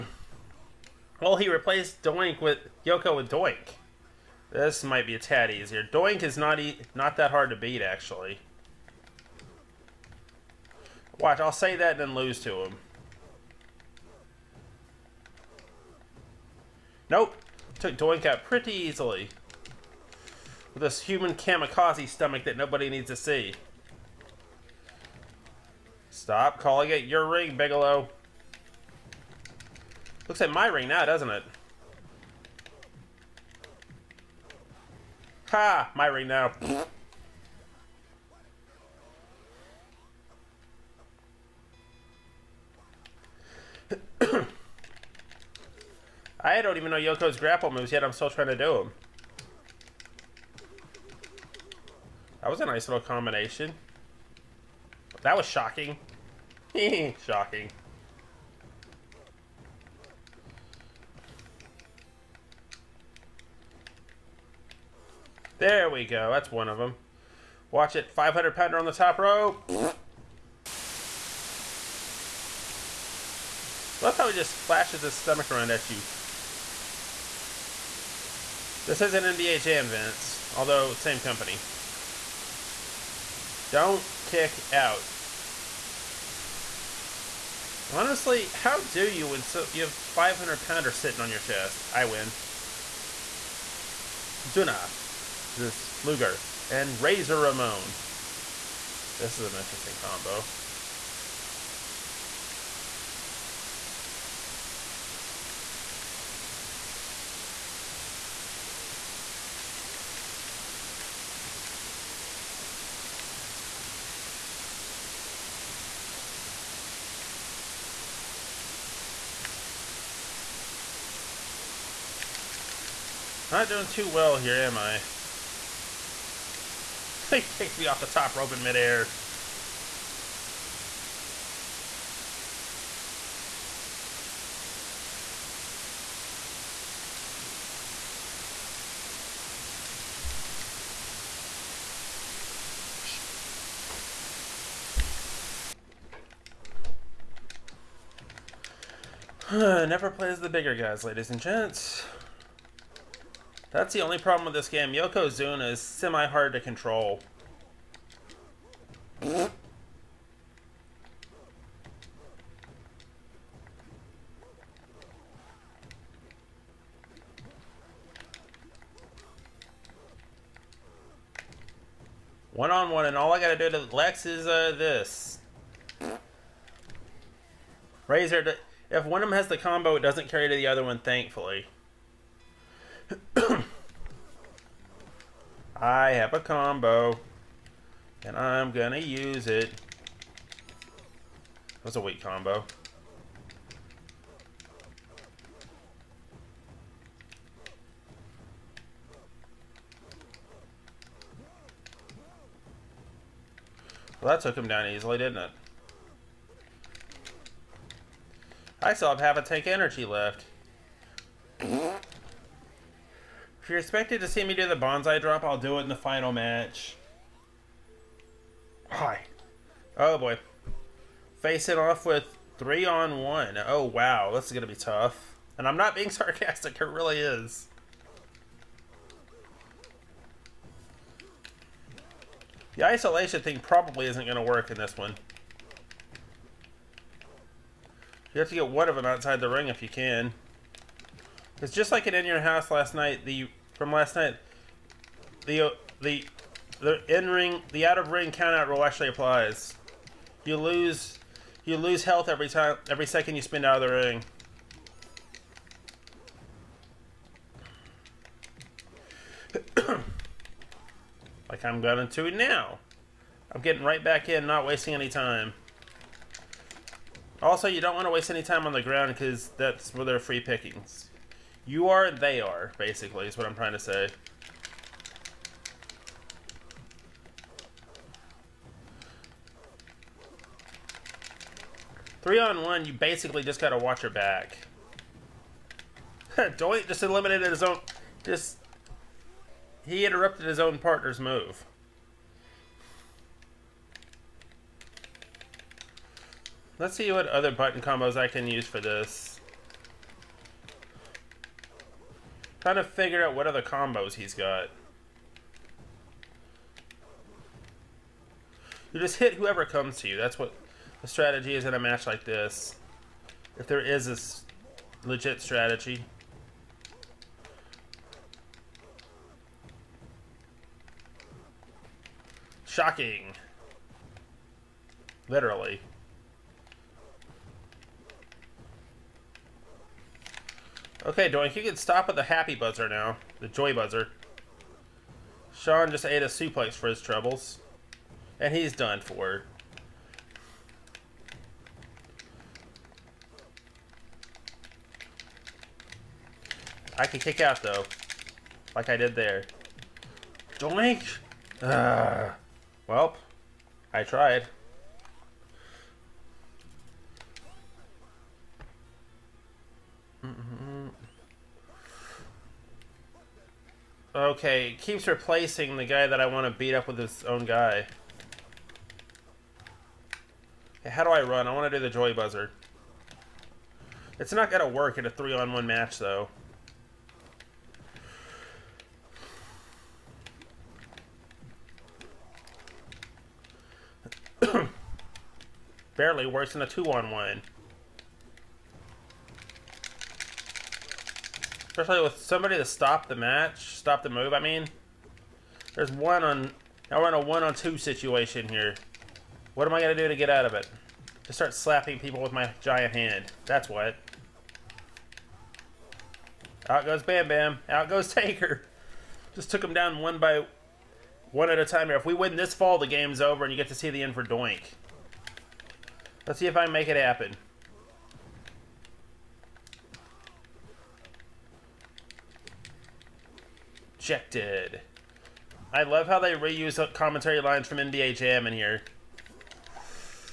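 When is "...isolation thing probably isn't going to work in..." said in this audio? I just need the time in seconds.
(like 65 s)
232 s.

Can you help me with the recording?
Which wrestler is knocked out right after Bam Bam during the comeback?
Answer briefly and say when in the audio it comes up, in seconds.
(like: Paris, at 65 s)
Taker, at 408 s.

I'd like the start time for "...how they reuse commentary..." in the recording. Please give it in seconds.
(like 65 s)
426 s.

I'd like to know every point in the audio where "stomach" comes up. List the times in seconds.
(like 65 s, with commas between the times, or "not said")
22 s, 75 s.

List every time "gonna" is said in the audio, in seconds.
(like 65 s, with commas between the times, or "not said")
188 s, 224 s.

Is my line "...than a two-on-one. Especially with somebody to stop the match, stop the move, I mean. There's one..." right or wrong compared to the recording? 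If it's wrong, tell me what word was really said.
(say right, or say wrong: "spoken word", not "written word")
right.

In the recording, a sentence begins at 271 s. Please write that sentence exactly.
You are, they are, basically, is what I'm trying to say.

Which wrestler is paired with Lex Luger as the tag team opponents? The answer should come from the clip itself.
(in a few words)
Razor Ramon.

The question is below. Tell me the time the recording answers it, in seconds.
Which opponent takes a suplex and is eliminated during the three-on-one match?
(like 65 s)
335 s.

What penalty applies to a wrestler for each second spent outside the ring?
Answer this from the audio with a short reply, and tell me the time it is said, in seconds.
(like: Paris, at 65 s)
lose health, at 251 s.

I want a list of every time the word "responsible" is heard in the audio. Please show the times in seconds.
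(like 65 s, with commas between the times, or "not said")
not said.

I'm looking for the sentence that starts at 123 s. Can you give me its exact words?
Not doing too well here, am I?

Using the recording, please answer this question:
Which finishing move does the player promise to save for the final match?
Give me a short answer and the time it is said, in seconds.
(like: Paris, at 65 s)
banzai drop, at 214 s.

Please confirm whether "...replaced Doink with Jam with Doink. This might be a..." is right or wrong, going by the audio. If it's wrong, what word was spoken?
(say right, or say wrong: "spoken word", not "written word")
wrong: "Yoko", not "Jam".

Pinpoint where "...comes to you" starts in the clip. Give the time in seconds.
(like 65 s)
309 s.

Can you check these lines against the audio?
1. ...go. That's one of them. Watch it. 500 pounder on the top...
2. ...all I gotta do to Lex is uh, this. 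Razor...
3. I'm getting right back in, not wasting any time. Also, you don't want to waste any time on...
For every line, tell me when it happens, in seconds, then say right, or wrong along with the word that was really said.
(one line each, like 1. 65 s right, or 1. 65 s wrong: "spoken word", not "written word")
1. 66 s right
2. 173 s right
3. 263 s right.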